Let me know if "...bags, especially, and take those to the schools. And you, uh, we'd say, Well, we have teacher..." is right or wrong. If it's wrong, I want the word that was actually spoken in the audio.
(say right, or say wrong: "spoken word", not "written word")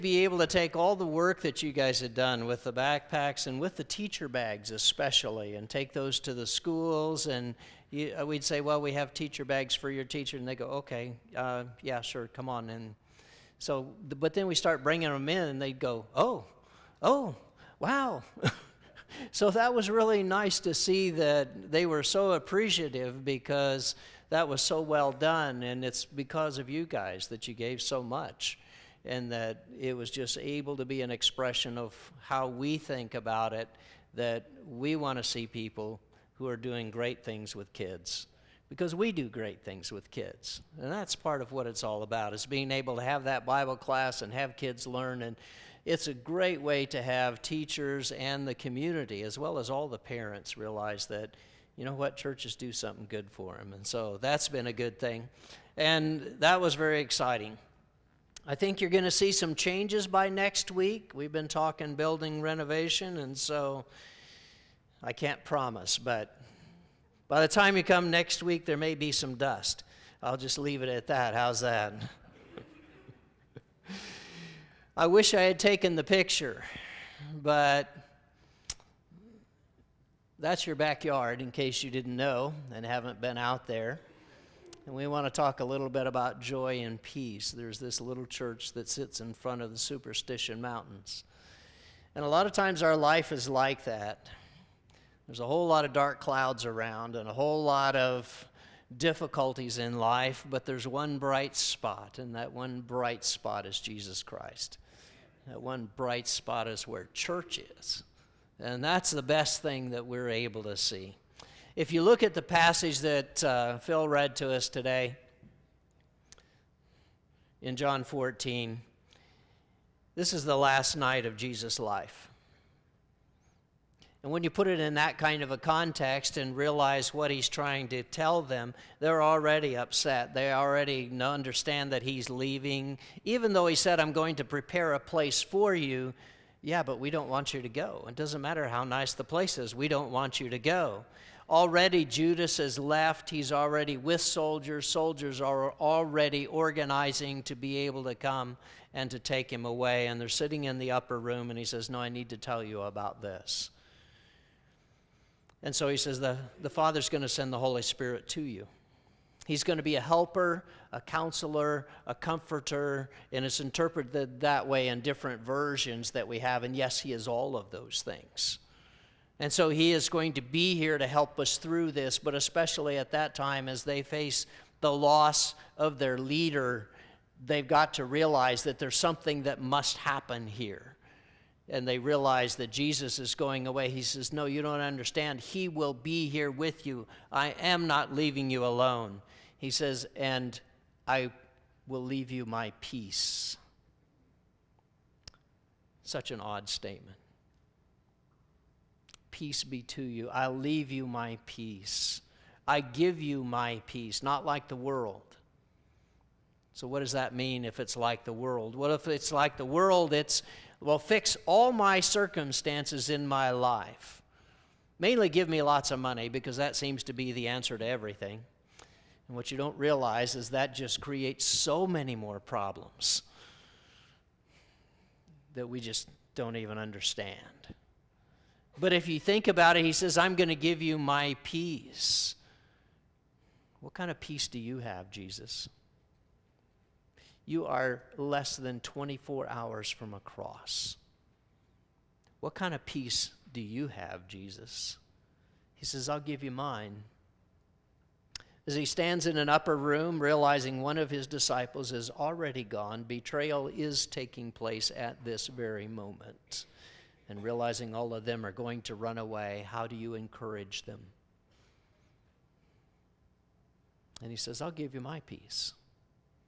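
right.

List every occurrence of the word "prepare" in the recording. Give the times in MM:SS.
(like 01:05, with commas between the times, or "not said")
02:14.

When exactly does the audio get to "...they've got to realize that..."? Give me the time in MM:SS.
02:57.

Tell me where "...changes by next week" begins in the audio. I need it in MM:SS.
00:59.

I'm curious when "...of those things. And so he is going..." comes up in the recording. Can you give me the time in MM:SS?
02:47.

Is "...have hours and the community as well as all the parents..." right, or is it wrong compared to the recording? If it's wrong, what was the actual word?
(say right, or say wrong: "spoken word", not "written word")
wrong: "teachers", not "hours".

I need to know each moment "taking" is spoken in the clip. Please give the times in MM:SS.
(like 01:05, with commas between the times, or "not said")
04:14.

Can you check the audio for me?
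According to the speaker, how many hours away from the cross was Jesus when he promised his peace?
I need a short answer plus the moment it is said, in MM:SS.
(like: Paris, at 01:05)
24, at 03:58.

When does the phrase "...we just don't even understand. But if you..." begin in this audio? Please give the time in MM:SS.
03:45.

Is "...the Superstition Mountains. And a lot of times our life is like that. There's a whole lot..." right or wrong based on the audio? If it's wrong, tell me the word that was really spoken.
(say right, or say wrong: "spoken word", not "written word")
right.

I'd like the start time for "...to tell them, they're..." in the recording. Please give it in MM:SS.
02:07.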